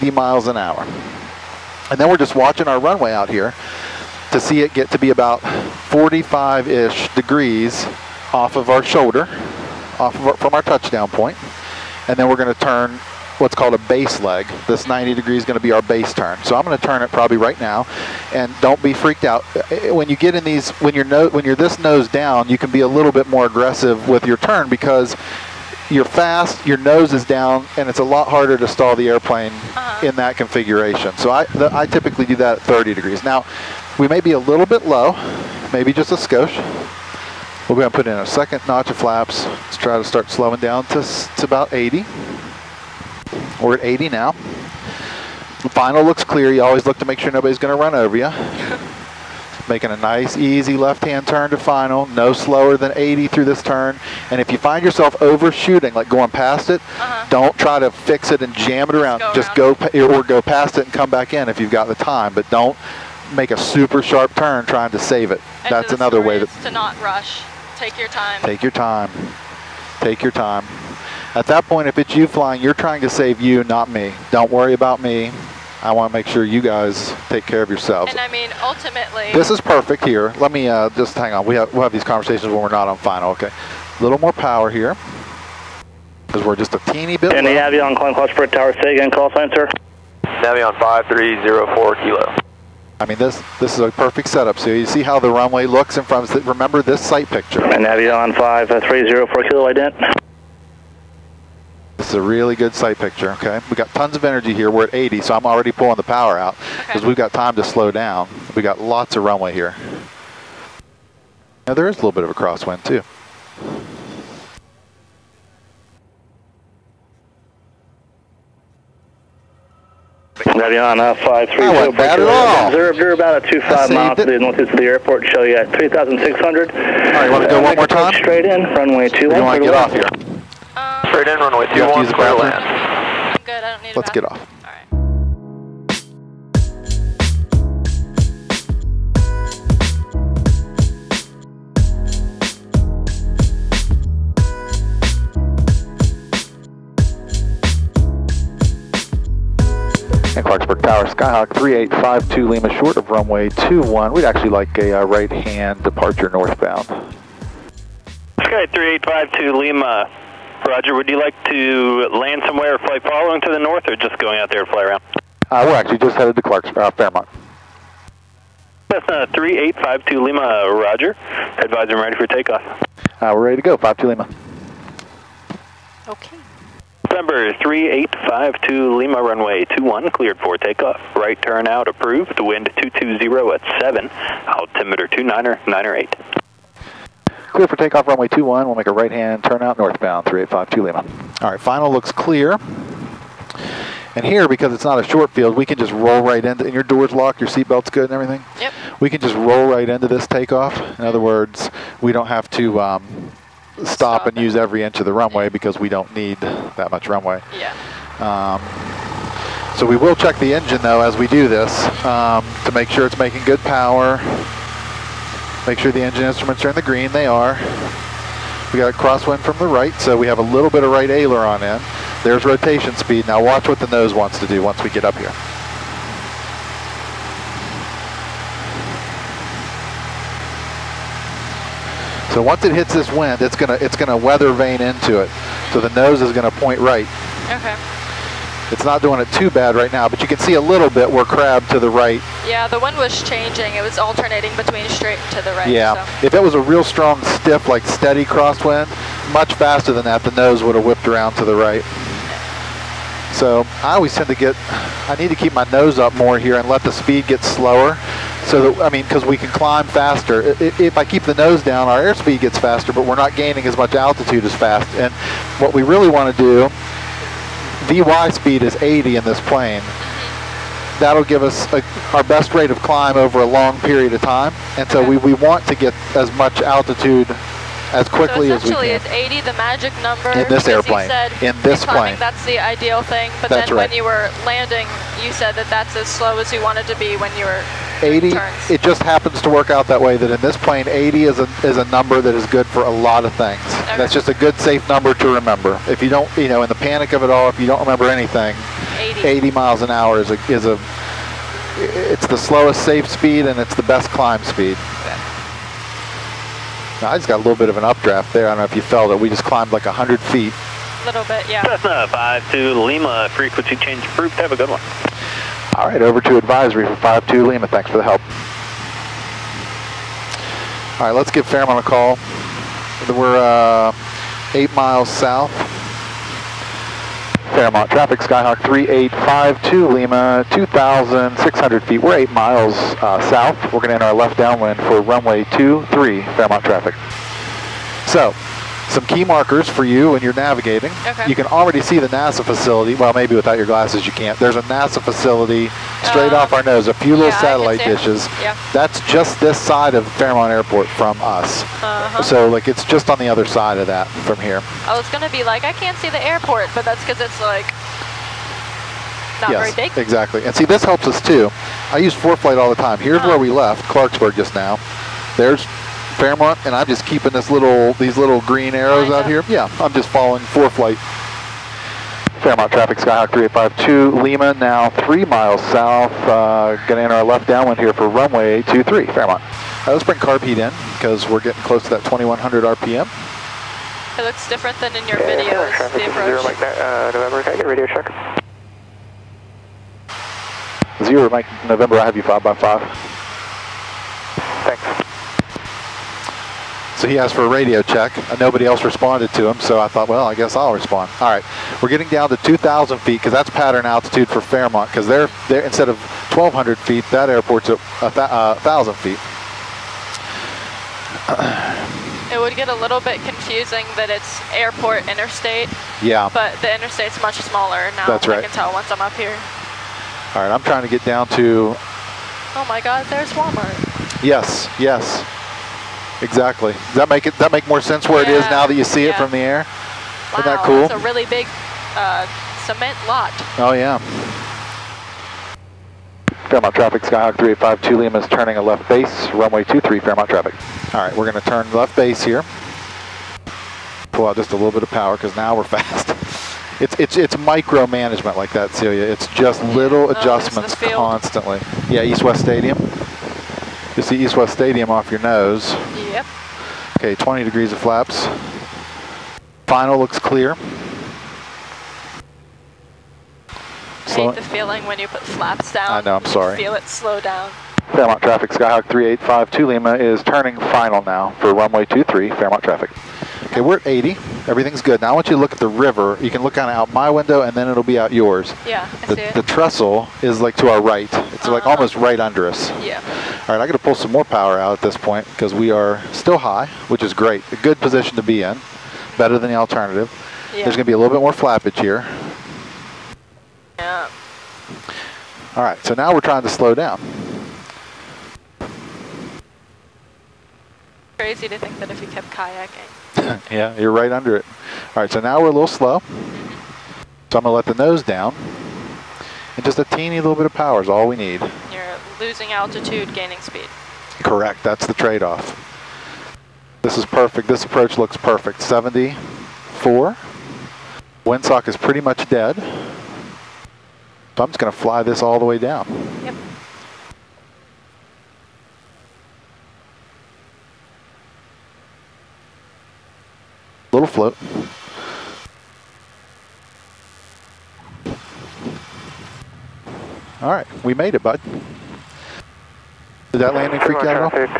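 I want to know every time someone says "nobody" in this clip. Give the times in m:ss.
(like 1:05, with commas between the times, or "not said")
0:47, 6:38.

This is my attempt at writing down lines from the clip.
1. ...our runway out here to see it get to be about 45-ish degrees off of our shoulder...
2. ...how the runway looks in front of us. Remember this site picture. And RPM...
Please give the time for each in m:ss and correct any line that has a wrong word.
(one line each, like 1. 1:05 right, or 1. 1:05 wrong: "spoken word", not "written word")
1. 0:02 right
2. 1:35 wrong: "Avion", not "RPM".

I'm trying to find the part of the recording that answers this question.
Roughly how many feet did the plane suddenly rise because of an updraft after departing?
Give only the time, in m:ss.
5:09.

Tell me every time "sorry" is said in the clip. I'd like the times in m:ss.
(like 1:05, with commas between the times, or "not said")
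7:46.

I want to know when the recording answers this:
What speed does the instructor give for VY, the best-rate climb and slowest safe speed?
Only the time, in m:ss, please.
4:27.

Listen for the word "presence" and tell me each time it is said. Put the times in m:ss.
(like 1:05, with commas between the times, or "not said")
not said.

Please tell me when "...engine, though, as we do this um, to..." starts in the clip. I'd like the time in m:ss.
3:30.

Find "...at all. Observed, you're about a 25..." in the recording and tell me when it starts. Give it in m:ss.
2:02.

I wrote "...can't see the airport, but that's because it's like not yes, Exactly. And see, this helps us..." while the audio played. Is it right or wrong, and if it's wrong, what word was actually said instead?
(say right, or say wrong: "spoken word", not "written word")
right.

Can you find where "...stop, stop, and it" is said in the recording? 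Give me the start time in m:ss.
3:23.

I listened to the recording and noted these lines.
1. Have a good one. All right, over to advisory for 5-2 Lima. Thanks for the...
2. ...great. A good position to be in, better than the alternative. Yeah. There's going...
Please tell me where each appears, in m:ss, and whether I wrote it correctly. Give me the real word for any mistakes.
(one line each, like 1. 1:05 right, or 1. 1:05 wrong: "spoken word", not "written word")
1. 5:14 right
2. 8:07 right.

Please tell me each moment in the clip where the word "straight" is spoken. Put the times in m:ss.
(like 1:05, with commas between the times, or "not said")
2:08, 4:04, 5:46.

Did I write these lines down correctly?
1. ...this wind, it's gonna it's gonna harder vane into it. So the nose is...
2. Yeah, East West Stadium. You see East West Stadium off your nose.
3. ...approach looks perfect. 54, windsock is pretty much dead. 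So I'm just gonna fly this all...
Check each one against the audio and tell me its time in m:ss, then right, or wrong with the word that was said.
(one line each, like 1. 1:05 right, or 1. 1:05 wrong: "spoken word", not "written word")
1. 3:52 wrong: "weather", not "harder"
2. 7:31 right
3. 8:37 wrong: "74", not "54".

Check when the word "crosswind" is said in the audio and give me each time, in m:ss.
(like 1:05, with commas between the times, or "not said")
1:52, 3:38, 4:08.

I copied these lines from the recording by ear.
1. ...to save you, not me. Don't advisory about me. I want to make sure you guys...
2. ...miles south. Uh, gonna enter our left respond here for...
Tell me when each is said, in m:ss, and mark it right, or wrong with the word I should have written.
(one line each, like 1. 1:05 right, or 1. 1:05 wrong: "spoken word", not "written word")
1. 1:13 wrong: "worry", not "advisory"
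2. 6:15 wrong: "downwind", not "respond".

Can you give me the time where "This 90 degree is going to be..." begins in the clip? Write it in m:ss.
0:14.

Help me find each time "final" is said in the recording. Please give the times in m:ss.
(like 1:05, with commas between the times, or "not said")
0:45, 0:51, 1:22, 3:11, 7:39, 7:50.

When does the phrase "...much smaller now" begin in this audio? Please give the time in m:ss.
6:57.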